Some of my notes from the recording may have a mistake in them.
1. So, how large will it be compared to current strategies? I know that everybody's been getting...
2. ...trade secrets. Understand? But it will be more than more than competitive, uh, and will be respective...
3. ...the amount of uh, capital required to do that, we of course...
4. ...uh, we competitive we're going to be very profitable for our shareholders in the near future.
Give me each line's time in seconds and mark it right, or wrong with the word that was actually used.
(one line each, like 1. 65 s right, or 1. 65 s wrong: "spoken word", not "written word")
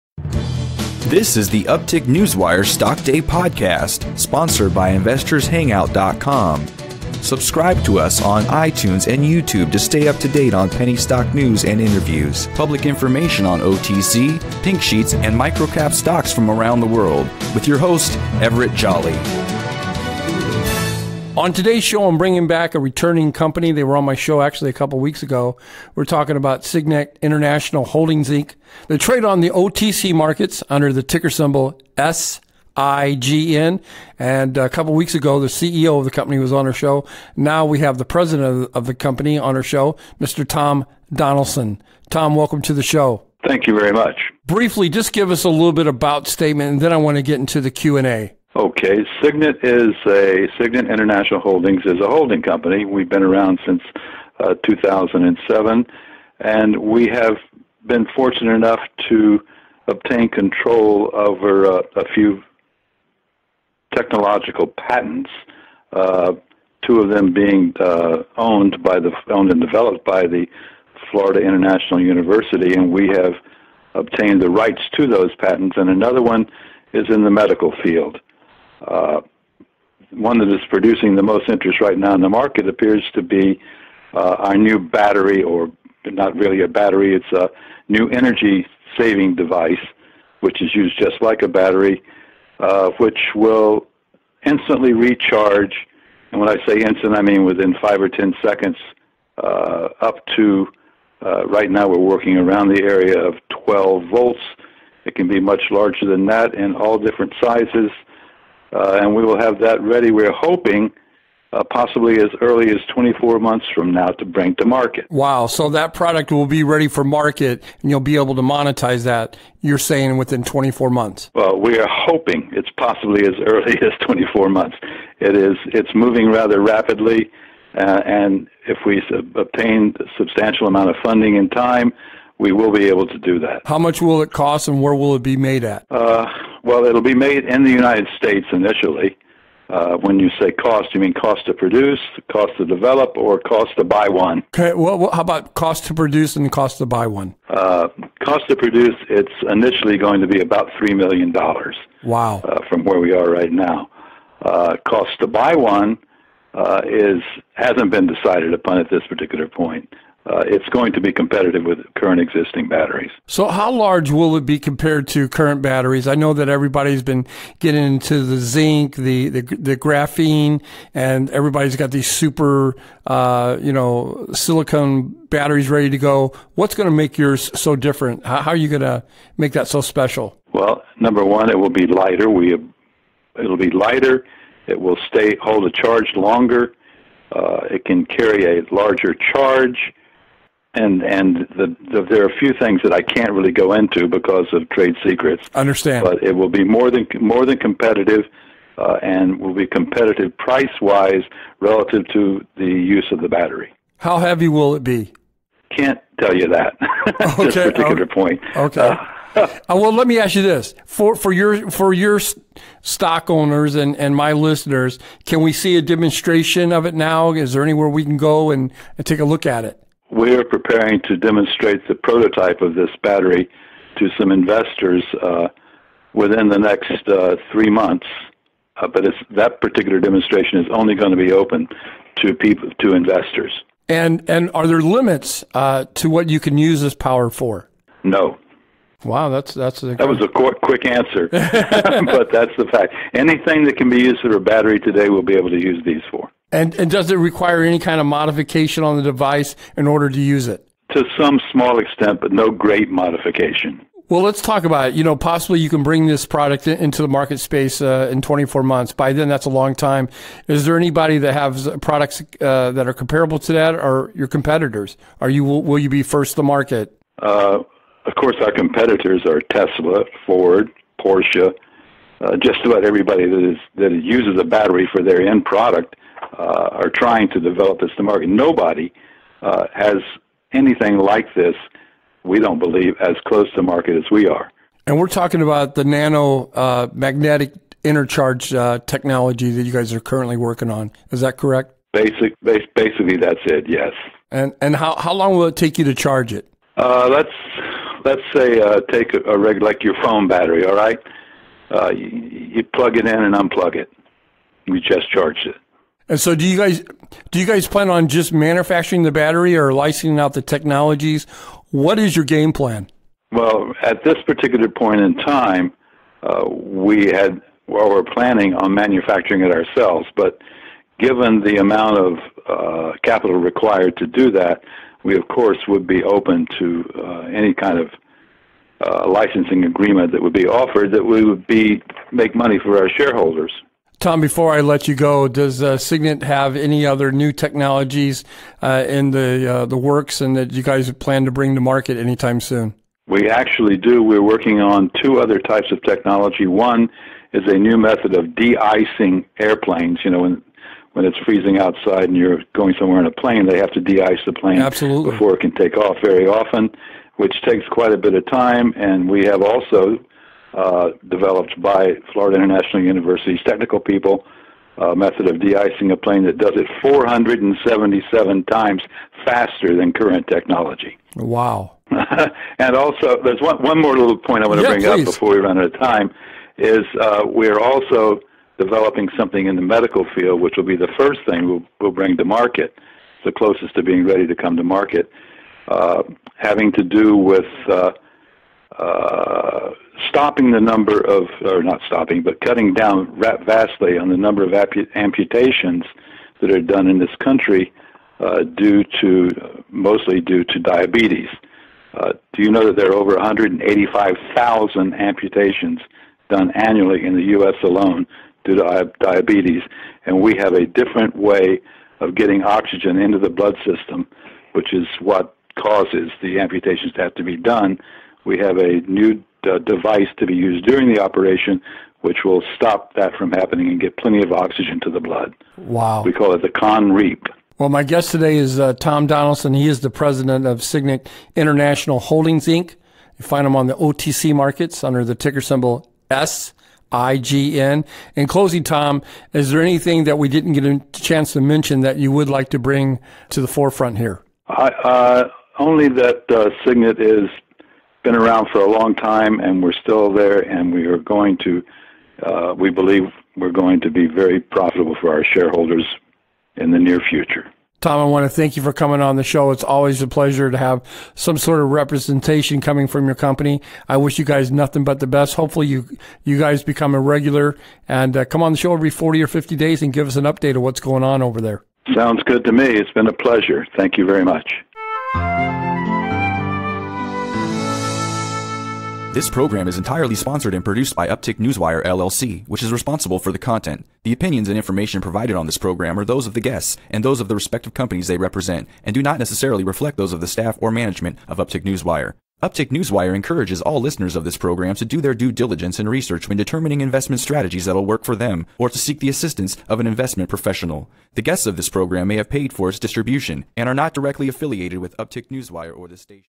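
1. 163 s wrong: "batteries", not "strategies"
2. 194 s wrong: "competitive", not "respective"
3. 321 s right
4. 452 s wrong: "believe", not "competitive".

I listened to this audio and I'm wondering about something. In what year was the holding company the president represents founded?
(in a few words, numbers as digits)
2007.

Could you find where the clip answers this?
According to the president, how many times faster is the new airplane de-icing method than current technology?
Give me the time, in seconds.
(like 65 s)
366 s.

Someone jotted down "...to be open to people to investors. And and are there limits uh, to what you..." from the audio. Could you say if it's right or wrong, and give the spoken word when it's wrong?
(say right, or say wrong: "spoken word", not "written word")
right.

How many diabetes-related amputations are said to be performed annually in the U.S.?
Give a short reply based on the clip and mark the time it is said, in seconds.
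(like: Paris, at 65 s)
185,000, at 403 s.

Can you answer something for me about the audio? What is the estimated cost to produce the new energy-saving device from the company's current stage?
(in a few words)
$3 million.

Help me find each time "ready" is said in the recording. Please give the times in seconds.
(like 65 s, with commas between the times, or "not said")
109 s, 116 s, 175 s, 384 s.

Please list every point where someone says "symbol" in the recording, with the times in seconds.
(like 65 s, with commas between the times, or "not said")
31 s, 435 s.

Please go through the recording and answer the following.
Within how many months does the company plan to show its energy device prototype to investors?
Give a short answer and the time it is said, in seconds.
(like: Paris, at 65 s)
3 months, at 227 s.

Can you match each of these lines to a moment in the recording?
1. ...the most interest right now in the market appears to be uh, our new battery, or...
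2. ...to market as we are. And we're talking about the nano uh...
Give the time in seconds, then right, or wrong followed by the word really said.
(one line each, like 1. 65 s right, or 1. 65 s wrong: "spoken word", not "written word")
1. 81 s right
2. 283 s right.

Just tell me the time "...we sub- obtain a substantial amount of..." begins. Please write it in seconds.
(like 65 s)
128 s.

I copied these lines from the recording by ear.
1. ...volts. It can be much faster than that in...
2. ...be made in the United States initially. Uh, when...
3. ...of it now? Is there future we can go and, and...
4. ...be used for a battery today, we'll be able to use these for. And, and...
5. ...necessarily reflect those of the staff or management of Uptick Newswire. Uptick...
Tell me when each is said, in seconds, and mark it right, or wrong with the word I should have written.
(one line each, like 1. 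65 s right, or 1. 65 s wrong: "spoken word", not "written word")
1. 104 s wrong: "larger", not "faster"
2. 137 s right
3. 216 s wrong: "anywhere", not "future"
4. 243 s right
5. 489 s right.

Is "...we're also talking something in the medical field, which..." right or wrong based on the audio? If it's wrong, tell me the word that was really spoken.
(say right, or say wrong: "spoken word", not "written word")
wrong: "developing", not "talking".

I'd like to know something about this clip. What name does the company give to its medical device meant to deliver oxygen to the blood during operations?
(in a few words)
con reap.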